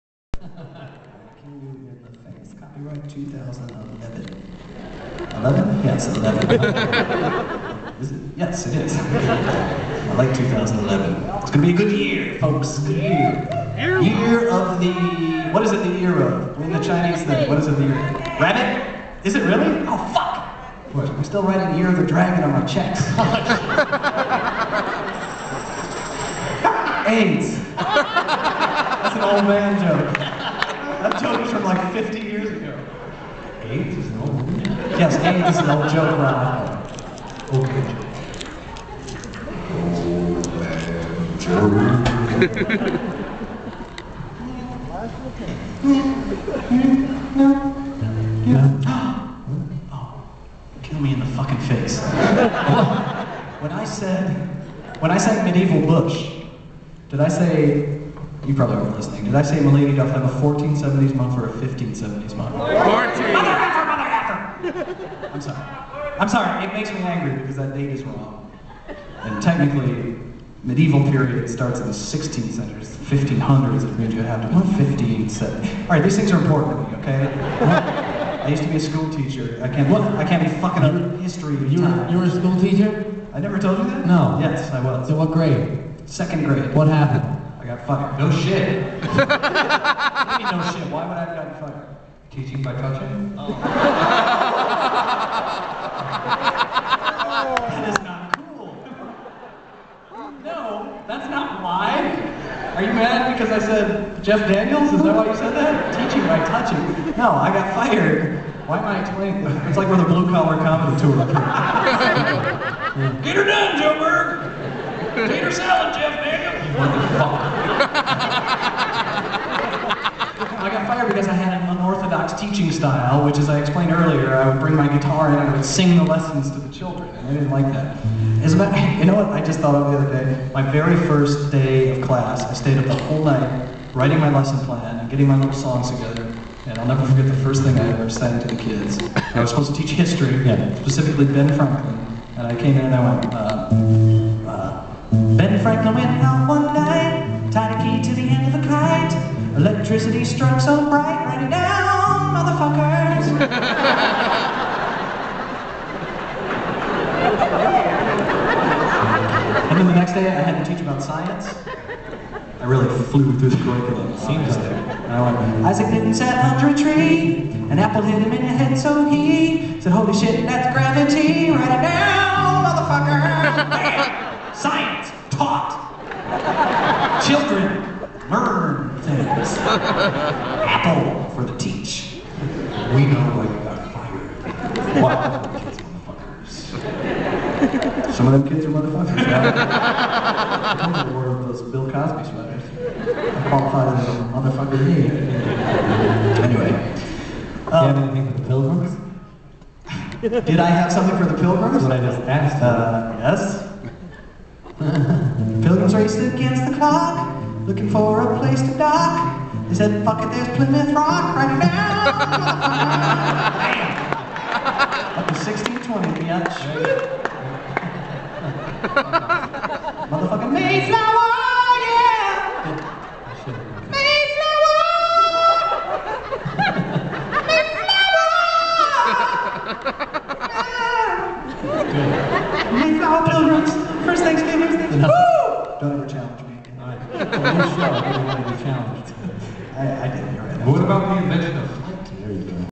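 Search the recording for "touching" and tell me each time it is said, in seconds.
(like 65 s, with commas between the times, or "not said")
92 s, 106 s.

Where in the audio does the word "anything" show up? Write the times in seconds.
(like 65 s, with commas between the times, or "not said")
198 s.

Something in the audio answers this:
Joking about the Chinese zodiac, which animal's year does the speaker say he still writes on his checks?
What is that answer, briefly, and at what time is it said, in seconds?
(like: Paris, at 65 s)
Dragon, at 22 s.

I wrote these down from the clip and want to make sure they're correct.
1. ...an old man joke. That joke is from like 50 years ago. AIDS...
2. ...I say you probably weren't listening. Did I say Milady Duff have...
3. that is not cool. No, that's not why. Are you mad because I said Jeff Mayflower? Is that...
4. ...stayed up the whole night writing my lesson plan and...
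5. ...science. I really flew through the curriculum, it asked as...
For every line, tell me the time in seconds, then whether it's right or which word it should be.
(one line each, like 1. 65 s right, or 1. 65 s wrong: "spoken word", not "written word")
1. 29 s right
2. 57 s right
3. 97 s wrong: "Daniels", not "Mayflower"
4. 132 s right
5. 161 s wrong: "seemed", not "asked".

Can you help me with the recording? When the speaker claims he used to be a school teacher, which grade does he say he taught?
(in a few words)
Second grade.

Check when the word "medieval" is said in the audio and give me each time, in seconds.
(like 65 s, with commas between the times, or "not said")
55 s, 70 s.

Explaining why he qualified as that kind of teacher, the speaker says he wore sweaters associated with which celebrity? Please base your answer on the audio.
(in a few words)
Bill Cosby.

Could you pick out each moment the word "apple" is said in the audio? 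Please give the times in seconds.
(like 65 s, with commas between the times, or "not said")
167 s, 179 s.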